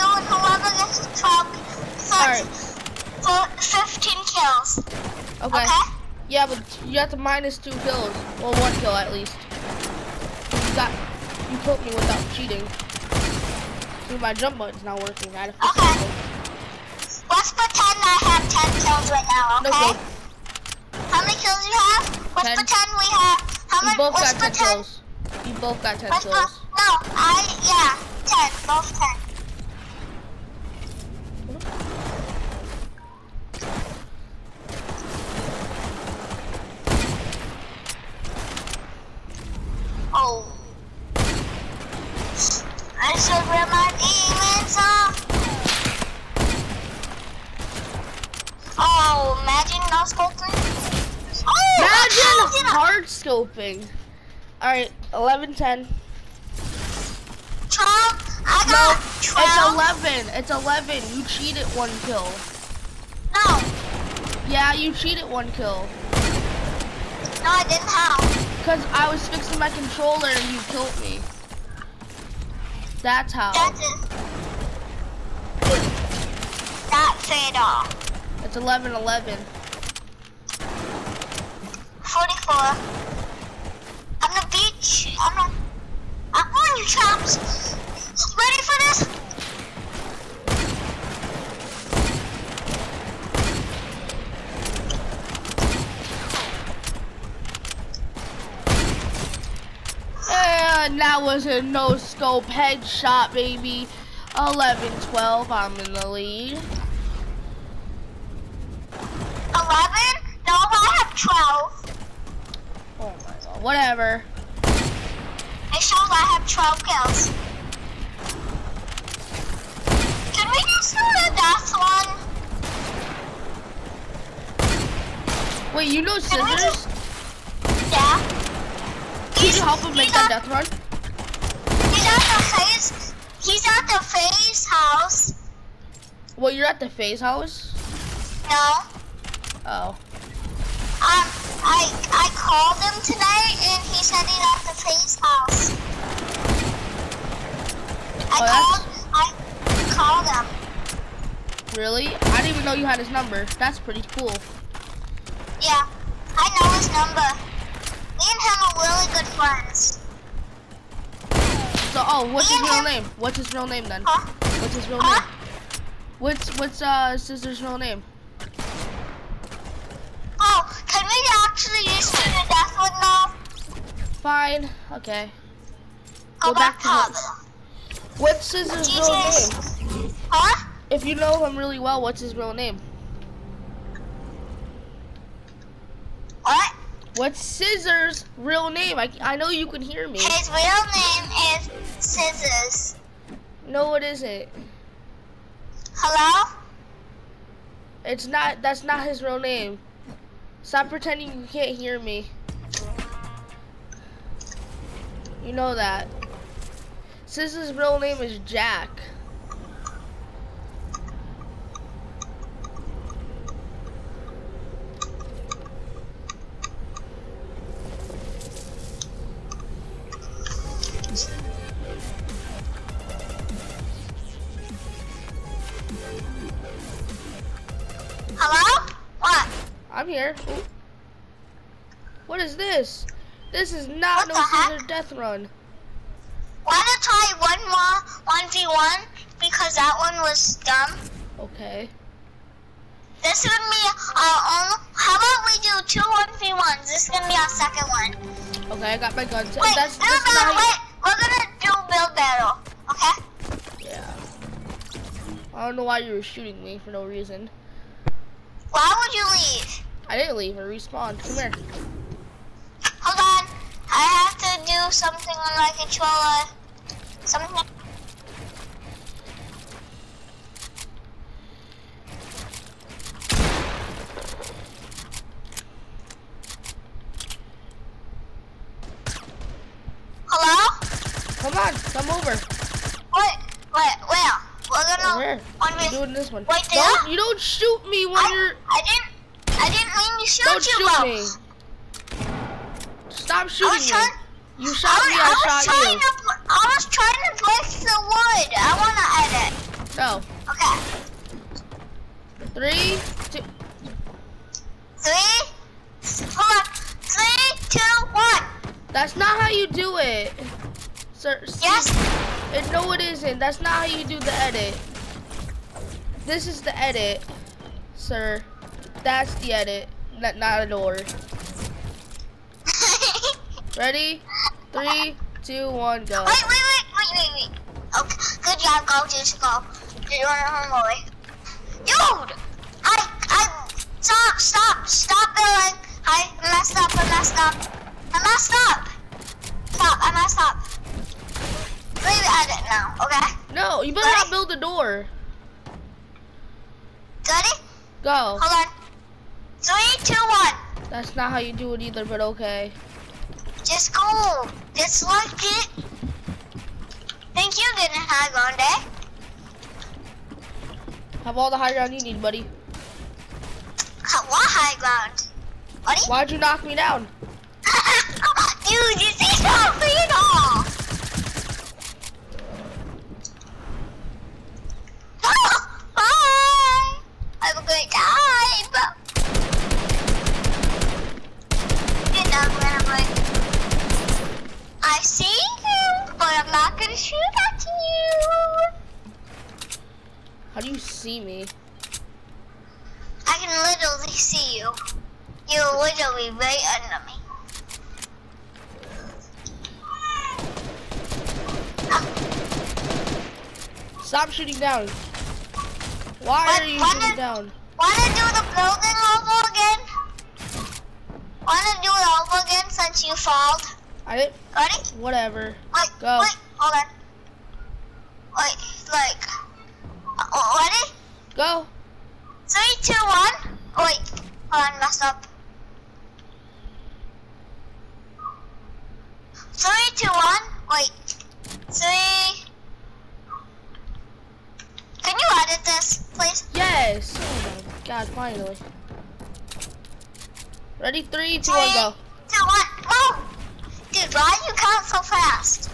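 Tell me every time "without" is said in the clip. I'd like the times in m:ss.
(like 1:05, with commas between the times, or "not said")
0:11.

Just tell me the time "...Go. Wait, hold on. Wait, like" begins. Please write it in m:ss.
6:55.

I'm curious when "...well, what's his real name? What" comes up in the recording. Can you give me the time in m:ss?
3:01.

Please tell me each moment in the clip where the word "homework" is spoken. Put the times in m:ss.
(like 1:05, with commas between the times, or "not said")
5:30.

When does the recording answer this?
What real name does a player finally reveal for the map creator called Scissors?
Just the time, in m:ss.
3:28.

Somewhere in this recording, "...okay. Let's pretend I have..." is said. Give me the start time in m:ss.
0:15.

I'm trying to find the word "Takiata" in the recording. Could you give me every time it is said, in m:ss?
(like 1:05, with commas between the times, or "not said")
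not said.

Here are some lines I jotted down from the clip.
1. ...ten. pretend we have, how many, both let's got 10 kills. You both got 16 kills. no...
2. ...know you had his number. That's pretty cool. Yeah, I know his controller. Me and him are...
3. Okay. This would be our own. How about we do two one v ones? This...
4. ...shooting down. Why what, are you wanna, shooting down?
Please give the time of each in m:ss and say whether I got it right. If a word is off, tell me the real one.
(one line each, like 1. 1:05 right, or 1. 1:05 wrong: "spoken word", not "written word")
1. 0:22 wrong: "10", not "16"
2. 2:32 wrong: "number", not "controller"
3. 4:01 right
4. 6:44 right.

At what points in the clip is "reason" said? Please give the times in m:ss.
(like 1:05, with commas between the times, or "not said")
4:17.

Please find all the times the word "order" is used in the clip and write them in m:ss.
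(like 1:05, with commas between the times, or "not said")
5:20.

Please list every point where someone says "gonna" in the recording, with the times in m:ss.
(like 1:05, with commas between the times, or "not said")
4:07, 4:11, 4:44.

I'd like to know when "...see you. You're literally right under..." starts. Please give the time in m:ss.
6:34.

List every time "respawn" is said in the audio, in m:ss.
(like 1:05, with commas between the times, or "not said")
4:20.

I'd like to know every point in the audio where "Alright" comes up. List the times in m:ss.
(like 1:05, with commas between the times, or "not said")
0:54.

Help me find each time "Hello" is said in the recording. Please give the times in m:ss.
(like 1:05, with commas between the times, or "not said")
3:15, 3:48.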